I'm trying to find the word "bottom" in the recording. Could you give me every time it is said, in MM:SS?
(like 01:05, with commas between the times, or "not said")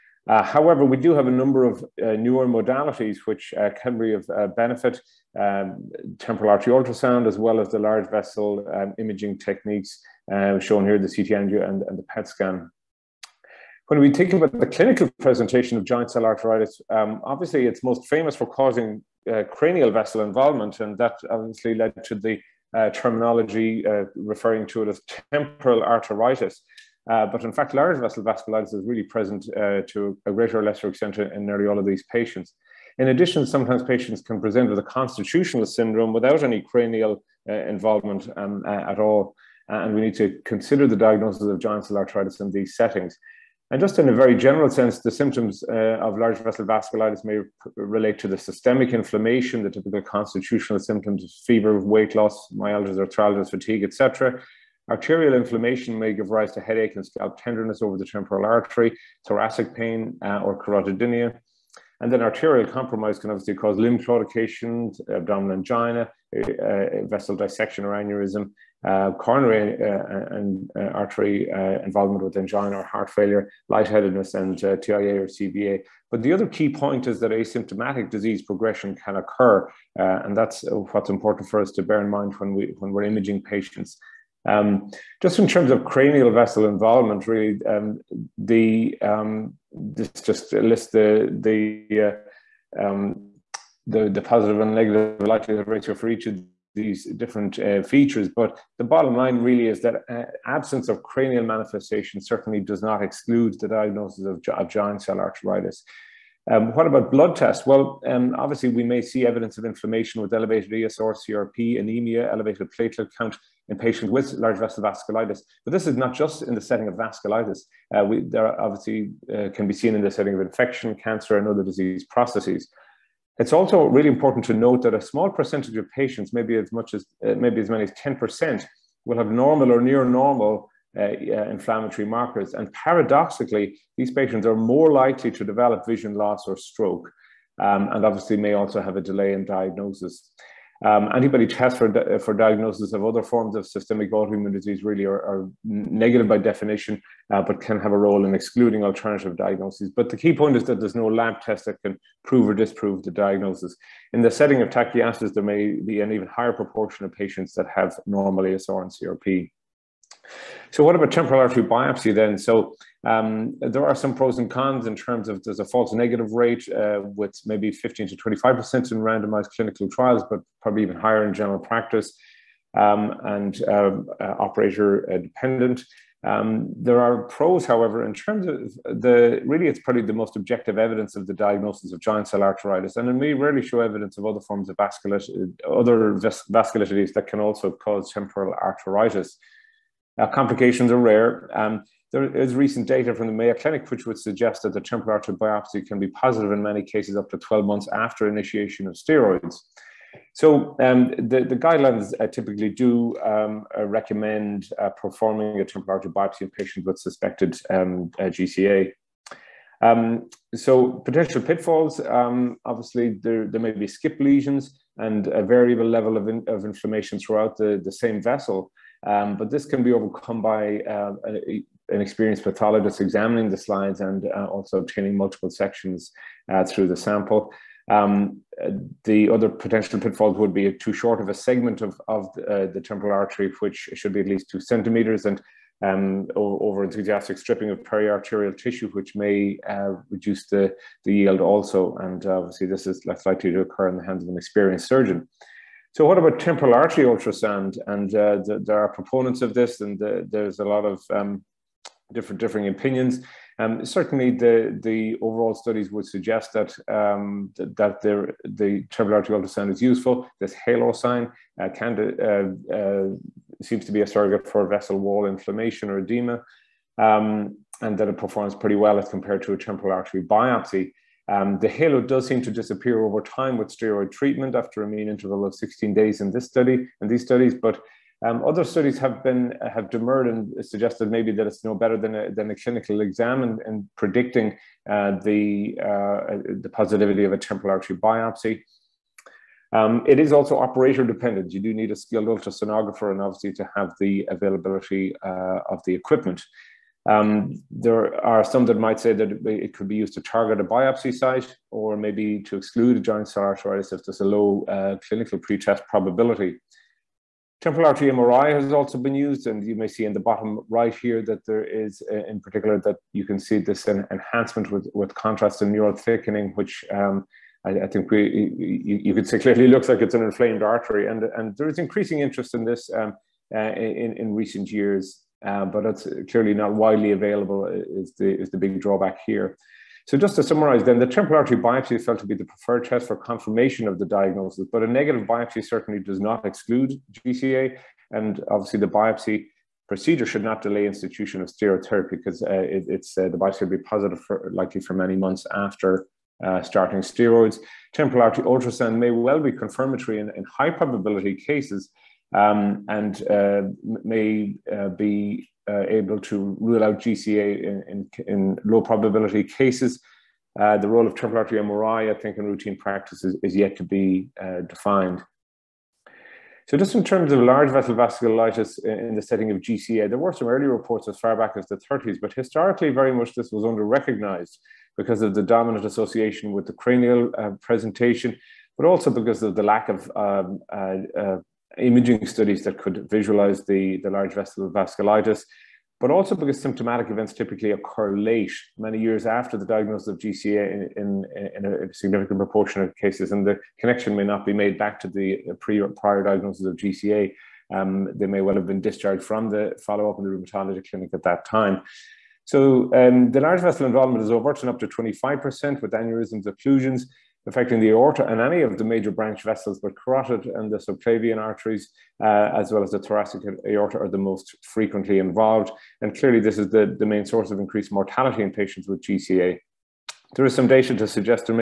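01:38, 05:10.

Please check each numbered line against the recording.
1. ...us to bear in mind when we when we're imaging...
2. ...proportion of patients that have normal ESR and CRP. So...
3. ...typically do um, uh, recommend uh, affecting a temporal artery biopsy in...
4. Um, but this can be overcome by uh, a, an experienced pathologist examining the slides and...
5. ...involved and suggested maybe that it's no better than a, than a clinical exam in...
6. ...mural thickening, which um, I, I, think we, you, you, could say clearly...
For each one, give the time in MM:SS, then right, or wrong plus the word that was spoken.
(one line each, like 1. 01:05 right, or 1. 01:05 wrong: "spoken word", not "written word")
1. 01:21 right
2. 02:36 right
3. 03:22 wrong: "performing", not "affecting"
4. 03:39 right
5. 04:39 wrong: "demurred", not "involved"
6. 05:15 right.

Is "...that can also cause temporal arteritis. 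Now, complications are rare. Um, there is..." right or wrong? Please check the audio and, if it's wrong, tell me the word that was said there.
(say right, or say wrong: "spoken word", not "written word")
right.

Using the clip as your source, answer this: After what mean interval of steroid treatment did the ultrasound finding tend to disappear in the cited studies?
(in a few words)
16 days.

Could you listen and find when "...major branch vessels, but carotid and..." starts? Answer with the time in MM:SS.
06:48.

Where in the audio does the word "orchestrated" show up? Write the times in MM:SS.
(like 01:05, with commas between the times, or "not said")
not said.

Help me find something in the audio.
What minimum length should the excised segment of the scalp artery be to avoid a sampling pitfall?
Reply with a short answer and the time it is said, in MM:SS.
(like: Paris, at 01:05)
2 centimeters, at 03:54.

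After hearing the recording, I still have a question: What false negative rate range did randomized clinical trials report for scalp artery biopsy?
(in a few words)
15 to 25%.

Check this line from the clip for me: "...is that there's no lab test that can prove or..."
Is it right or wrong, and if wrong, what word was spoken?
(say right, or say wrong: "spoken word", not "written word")
right.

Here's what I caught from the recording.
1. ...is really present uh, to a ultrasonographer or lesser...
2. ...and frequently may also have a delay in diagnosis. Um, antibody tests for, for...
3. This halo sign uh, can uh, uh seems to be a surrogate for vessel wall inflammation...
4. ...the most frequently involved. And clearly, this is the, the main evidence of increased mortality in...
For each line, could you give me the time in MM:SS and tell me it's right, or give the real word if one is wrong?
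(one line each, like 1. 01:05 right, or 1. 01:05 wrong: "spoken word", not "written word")
1. 00:28 wrong: "greater", not "ultrasonographer"
2. 02:17 wrong: "obviously", not "frequently"
3. 04:20 right
4. 06:54 wrong: "source", not "evidence".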